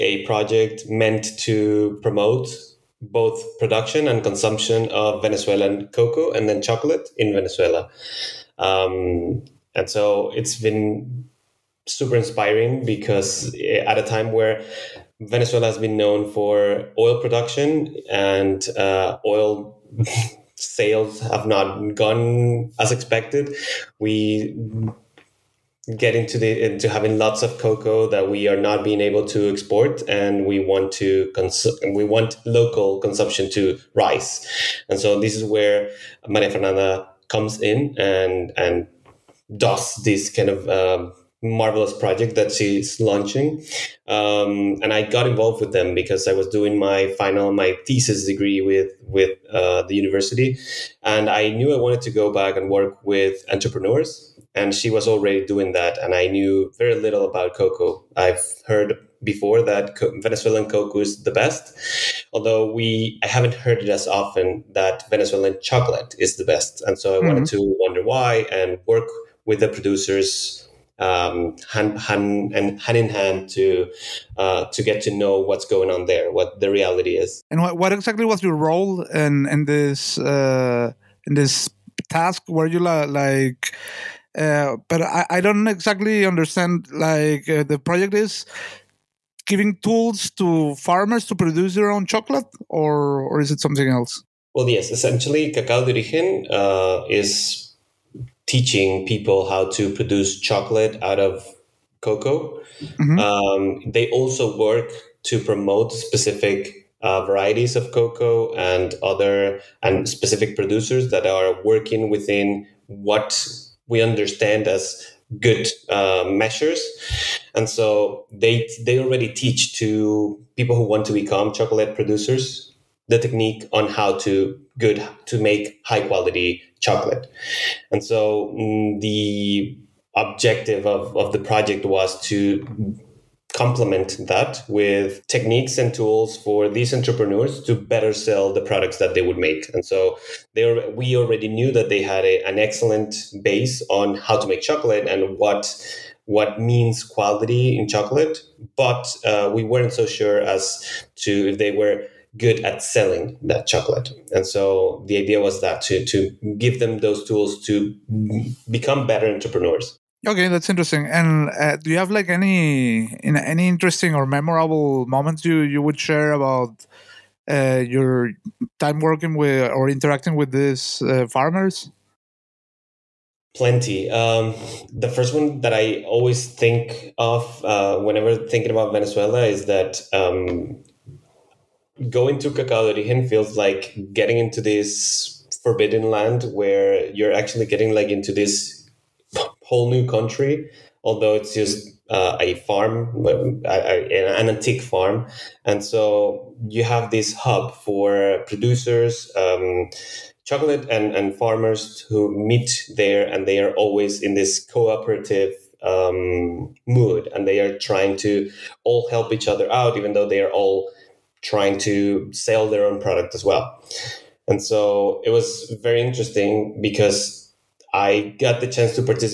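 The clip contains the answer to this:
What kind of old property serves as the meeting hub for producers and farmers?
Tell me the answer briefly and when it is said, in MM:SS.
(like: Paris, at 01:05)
an antique farm, at 03:13.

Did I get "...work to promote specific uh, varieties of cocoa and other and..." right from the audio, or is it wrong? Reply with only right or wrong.
right.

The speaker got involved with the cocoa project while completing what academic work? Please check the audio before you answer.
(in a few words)
thesis degree.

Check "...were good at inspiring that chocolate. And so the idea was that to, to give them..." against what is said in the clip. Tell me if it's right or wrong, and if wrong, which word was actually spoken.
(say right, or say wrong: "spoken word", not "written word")
wrong: "selling", not "inspiring".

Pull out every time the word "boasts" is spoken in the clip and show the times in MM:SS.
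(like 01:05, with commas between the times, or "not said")
not said.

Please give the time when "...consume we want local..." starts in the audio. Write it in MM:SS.
00:31.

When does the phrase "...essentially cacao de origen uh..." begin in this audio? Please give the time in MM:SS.
01:34.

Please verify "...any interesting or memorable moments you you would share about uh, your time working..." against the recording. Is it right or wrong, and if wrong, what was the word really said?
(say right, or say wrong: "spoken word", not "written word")
right.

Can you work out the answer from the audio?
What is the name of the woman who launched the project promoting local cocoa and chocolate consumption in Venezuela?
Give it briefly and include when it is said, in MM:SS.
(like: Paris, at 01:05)
Maria Fernanda, at 00:36.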